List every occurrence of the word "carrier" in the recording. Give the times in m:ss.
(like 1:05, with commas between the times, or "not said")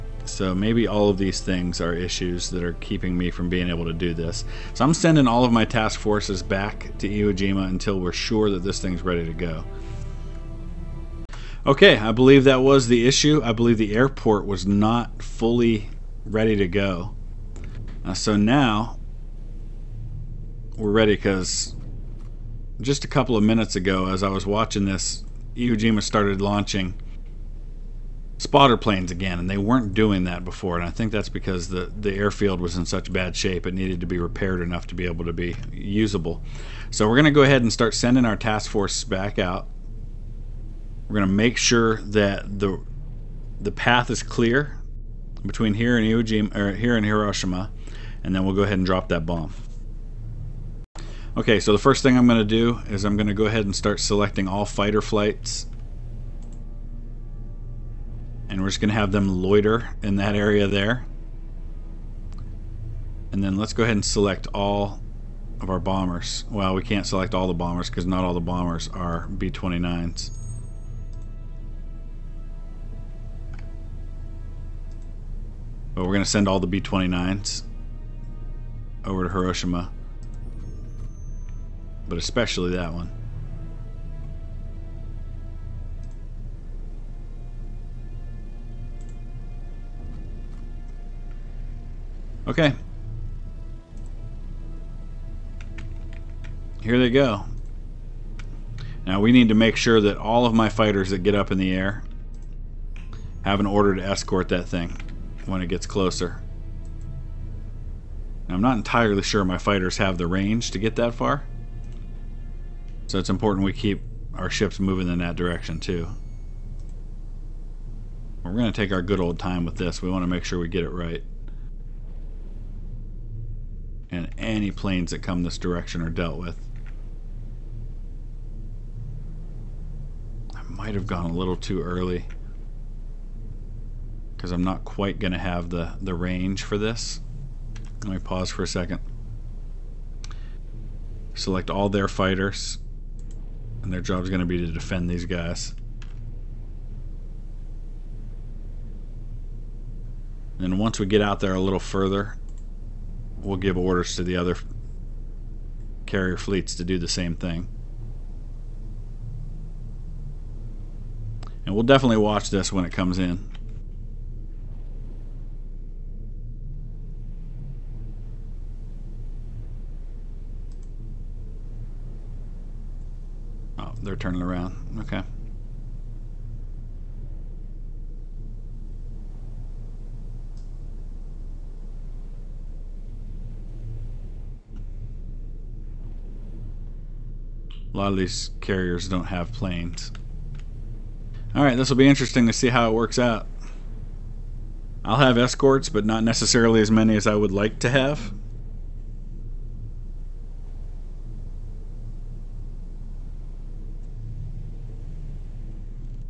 2:36, 3:08.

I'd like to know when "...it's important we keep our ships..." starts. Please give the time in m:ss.
1:53.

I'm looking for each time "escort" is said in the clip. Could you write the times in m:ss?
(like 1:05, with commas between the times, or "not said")
1:44, 3:15.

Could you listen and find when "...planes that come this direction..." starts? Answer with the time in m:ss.
2:04.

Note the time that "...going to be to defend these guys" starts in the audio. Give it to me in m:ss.
2:24.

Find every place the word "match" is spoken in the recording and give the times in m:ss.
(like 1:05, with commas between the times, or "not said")
not said.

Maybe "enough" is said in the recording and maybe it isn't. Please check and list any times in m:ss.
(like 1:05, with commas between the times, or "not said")
0:34.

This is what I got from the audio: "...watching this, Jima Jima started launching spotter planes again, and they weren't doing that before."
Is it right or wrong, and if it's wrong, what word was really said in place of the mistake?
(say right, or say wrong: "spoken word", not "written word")
wrong: "Iwo", not "Jima".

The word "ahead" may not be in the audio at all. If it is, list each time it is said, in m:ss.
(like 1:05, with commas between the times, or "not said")
0:37, 0:48, 0:53, 1:03.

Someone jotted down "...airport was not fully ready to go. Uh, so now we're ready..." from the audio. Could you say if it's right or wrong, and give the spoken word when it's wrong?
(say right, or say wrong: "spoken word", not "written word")
right.